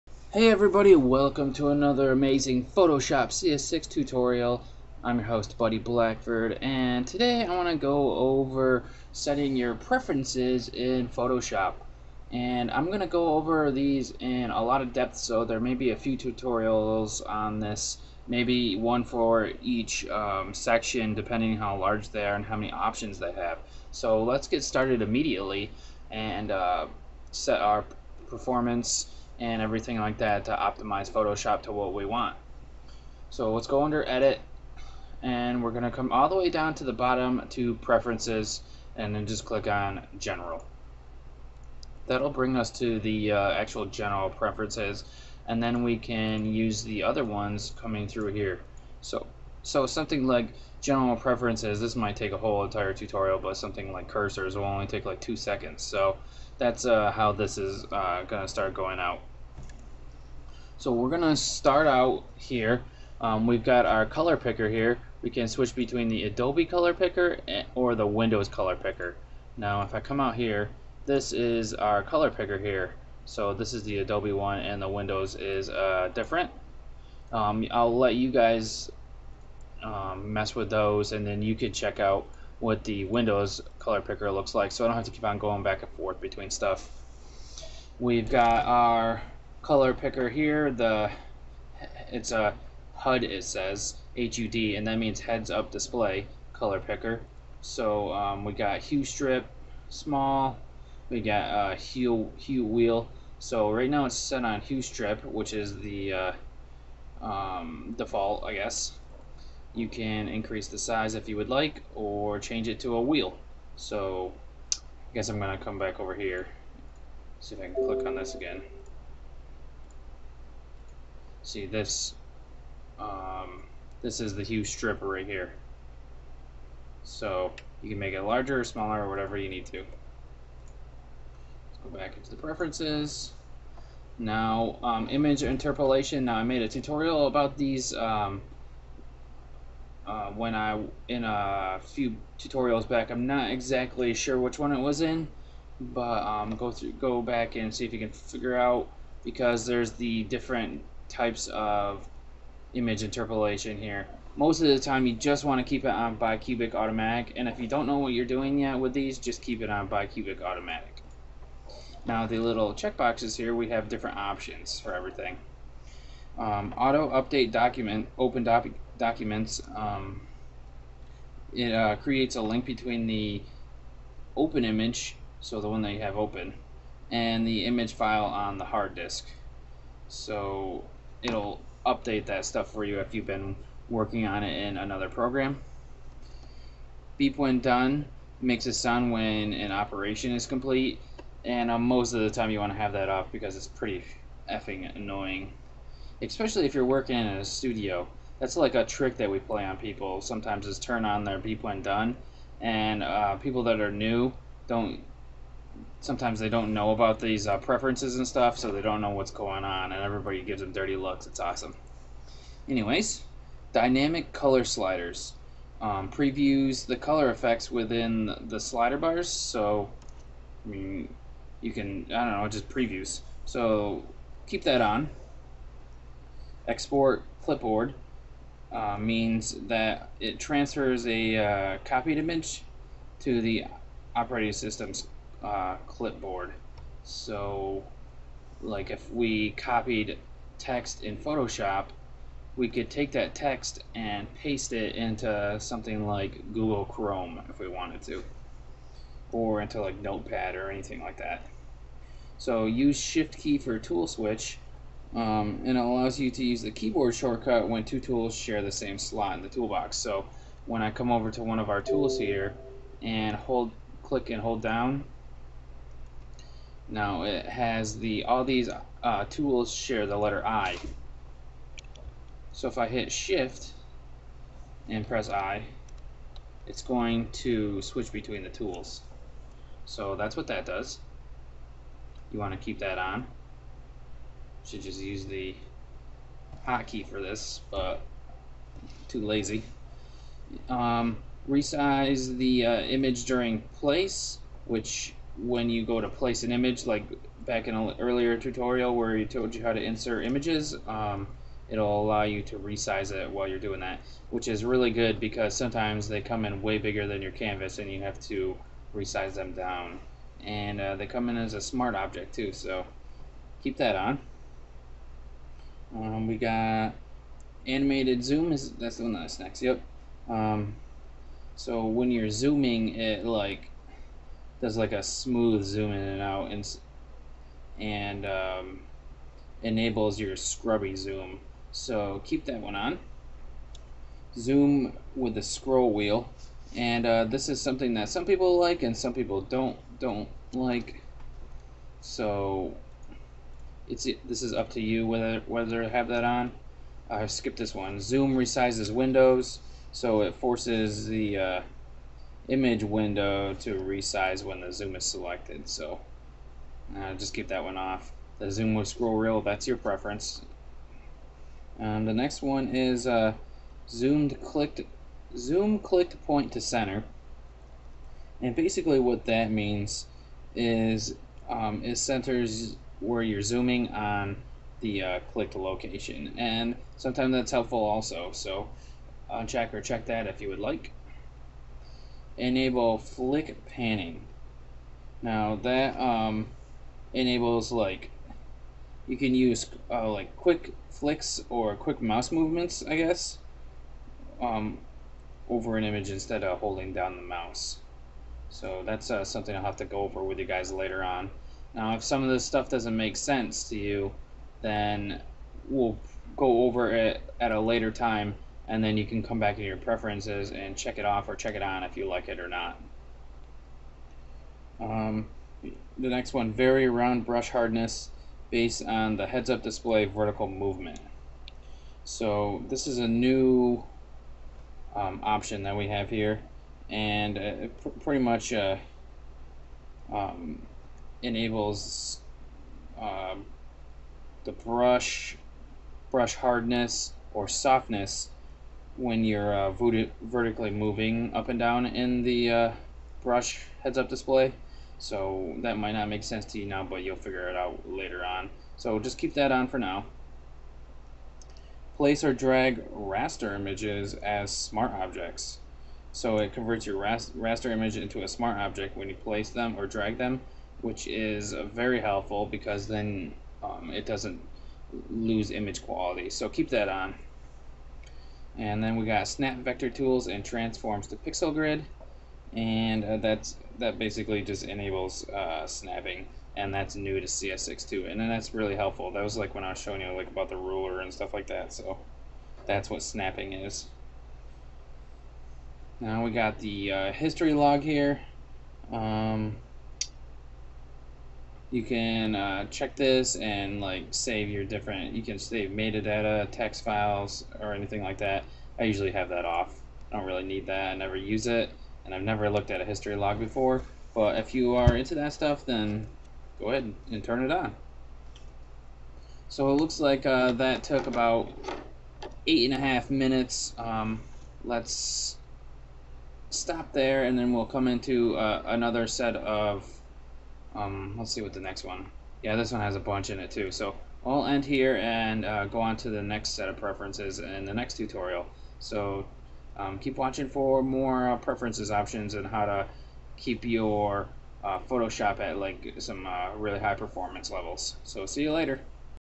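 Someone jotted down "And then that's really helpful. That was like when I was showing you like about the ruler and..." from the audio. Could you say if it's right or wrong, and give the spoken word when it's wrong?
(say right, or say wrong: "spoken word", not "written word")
right.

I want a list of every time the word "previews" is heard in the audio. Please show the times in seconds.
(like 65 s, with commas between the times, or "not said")
216 s, 222 s.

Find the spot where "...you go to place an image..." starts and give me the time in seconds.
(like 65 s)
295 s.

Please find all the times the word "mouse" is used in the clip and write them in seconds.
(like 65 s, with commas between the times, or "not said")
392 s, 397 s.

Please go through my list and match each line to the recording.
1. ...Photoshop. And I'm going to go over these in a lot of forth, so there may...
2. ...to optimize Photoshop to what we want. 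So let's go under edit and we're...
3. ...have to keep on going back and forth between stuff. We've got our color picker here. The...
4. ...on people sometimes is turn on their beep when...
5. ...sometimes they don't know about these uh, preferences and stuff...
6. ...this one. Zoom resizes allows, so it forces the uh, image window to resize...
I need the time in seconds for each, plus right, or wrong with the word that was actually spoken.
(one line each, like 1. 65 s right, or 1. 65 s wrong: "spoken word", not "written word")
1. 11 s wrong: "depth", not "forth"
2. 30 s right
3. 84 s right
4. 199 s right
5. 206 s right
6. 347 s wrong: "windows", not "allows".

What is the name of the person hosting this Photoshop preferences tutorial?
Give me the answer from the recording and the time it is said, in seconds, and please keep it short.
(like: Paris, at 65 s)
Buddy Blackford, at 5 s.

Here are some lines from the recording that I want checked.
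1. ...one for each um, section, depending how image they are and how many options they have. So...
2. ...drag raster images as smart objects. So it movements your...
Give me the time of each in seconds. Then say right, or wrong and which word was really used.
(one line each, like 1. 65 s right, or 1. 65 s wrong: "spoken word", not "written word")
1. 18 s wrong: "large", not "image"
2. 452 s wrong: "converts", not "movements".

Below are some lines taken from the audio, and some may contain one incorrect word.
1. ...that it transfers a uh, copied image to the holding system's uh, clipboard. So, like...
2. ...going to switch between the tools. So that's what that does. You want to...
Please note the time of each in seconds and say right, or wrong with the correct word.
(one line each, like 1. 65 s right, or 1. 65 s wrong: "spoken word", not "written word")
1. 229 s wrong: "operating", not "holding"
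2. 276 s right.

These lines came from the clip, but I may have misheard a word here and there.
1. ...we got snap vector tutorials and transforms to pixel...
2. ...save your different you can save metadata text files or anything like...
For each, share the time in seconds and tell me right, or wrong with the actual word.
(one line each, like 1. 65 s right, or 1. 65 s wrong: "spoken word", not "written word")
1. 468 s wrong: "tools", not "tutorials"
2. 494 s right.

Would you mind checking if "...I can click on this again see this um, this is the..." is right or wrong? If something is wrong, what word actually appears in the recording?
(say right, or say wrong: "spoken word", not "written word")
right.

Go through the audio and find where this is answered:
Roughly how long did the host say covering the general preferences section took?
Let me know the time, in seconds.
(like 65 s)
512 s.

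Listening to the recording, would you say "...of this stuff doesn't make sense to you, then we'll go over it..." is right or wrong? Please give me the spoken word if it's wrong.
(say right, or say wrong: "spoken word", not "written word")
right.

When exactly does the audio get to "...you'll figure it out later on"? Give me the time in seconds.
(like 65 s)
447 s.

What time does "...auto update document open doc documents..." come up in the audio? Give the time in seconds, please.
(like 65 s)
166 s.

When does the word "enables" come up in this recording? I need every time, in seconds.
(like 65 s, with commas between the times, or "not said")
329 s, 382 s, 387 s, 431 s, 474 s.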